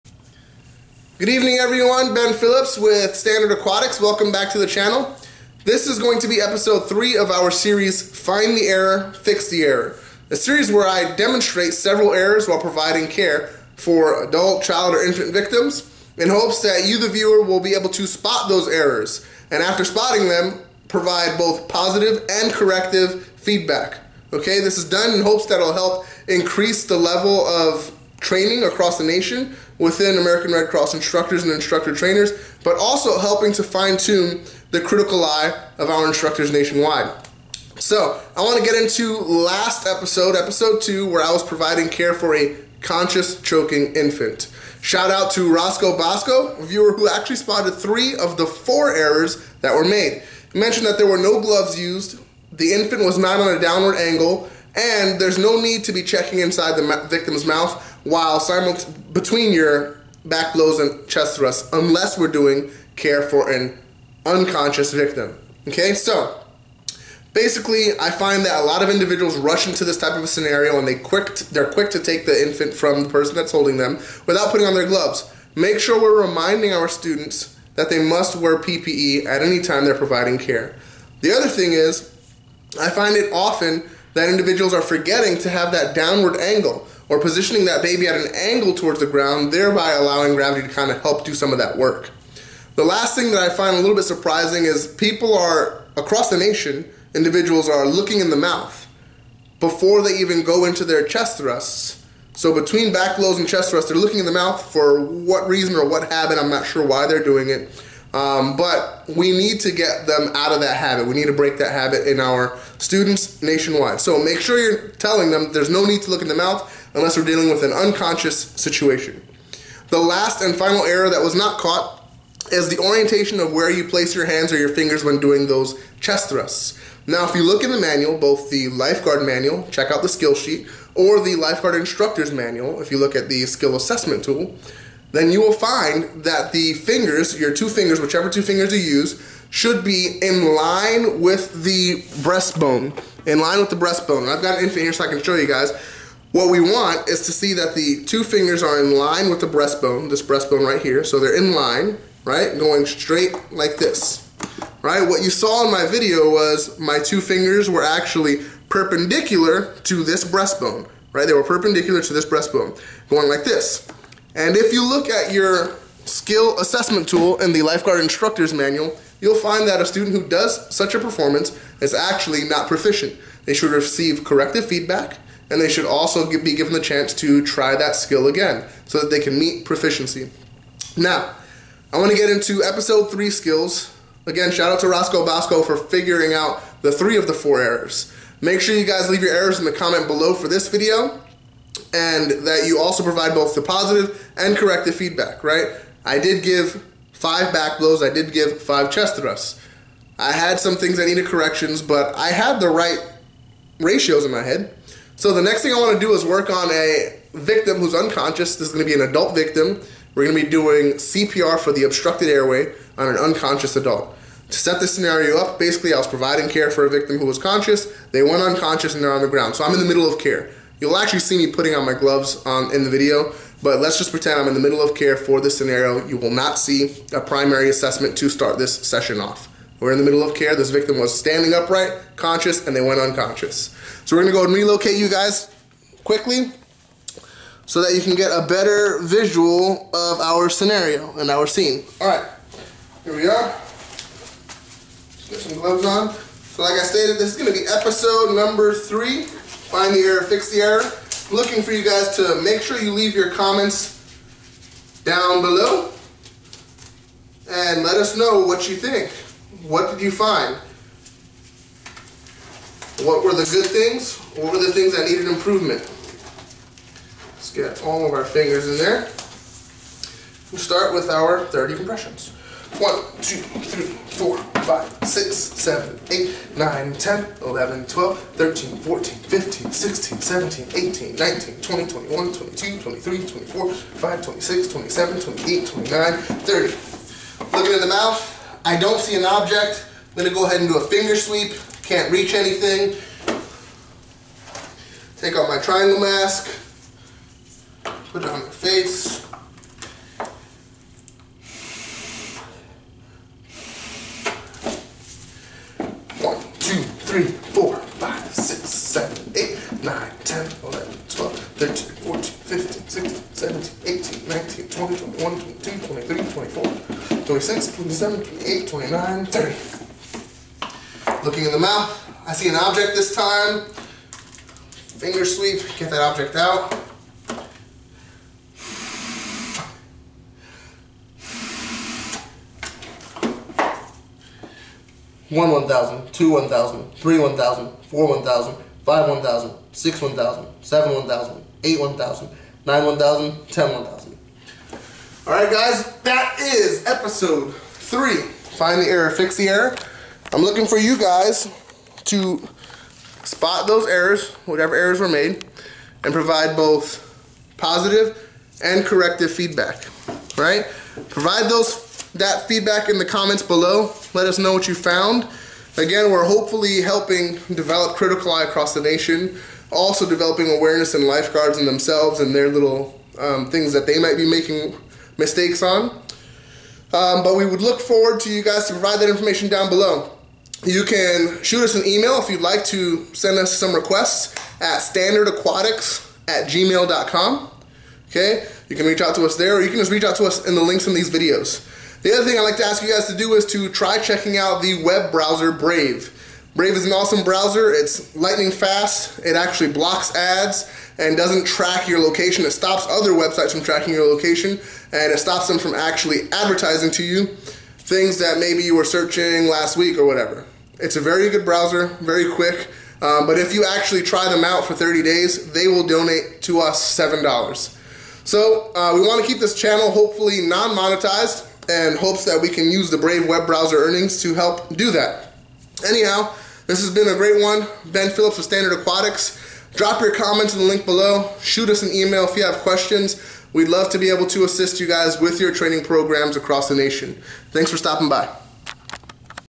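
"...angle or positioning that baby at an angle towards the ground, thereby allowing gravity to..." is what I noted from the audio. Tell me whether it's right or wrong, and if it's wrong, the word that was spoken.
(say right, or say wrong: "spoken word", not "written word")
right.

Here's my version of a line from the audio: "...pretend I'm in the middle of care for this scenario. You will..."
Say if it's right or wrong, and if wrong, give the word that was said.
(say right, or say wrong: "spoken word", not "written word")
right.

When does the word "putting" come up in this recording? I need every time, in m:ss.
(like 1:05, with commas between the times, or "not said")
1:14, 3:41.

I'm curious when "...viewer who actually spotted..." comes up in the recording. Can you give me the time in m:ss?
0:46.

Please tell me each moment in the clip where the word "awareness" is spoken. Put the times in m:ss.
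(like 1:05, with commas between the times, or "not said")
6:10.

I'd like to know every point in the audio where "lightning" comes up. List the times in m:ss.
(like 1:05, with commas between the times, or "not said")
6:38.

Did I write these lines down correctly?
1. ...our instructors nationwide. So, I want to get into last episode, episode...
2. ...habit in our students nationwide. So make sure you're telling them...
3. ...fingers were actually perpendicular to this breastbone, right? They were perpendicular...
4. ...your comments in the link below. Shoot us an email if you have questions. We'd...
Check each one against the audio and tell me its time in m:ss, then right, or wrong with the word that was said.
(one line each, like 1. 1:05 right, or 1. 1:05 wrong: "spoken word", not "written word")
1. 0:35 right
2. 1:51 right
3. 2:37 right
4. 7:10 right.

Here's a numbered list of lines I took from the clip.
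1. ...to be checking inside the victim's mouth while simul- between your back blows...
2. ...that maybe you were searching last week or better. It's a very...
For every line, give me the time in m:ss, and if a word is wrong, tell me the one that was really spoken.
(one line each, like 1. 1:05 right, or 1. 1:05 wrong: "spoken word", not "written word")
1. 0:55 right
2. 6:48 wrong: "whatever", not "better".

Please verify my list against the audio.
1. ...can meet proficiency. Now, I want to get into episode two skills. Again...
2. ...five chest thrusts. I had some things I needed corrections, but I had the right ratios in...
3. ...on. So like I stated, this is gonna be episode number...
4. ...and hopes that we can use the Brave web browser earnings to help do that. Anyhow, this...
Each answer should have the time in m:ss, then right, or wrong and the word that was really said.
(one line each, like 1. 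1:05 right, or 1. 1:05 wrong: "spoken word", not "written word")
1. 2:59 wrong: "three", not "two"
2. 3:18 right
3. 4:05 right
4. 7:01 right.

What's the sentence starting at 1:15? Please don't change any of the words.
Make sure we're reminding our students that they must wear PPE at any time they're providing care.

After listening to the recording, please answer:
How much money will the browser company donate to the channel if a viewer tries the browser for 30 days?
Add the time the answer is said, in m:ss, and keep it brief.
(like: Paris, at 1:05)
$7, at 6:56.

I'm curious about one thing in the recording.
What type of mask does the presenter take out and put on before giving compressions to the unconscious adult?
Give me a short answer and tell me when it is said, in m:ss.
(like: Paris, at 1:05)
triangle mask, at 4:55.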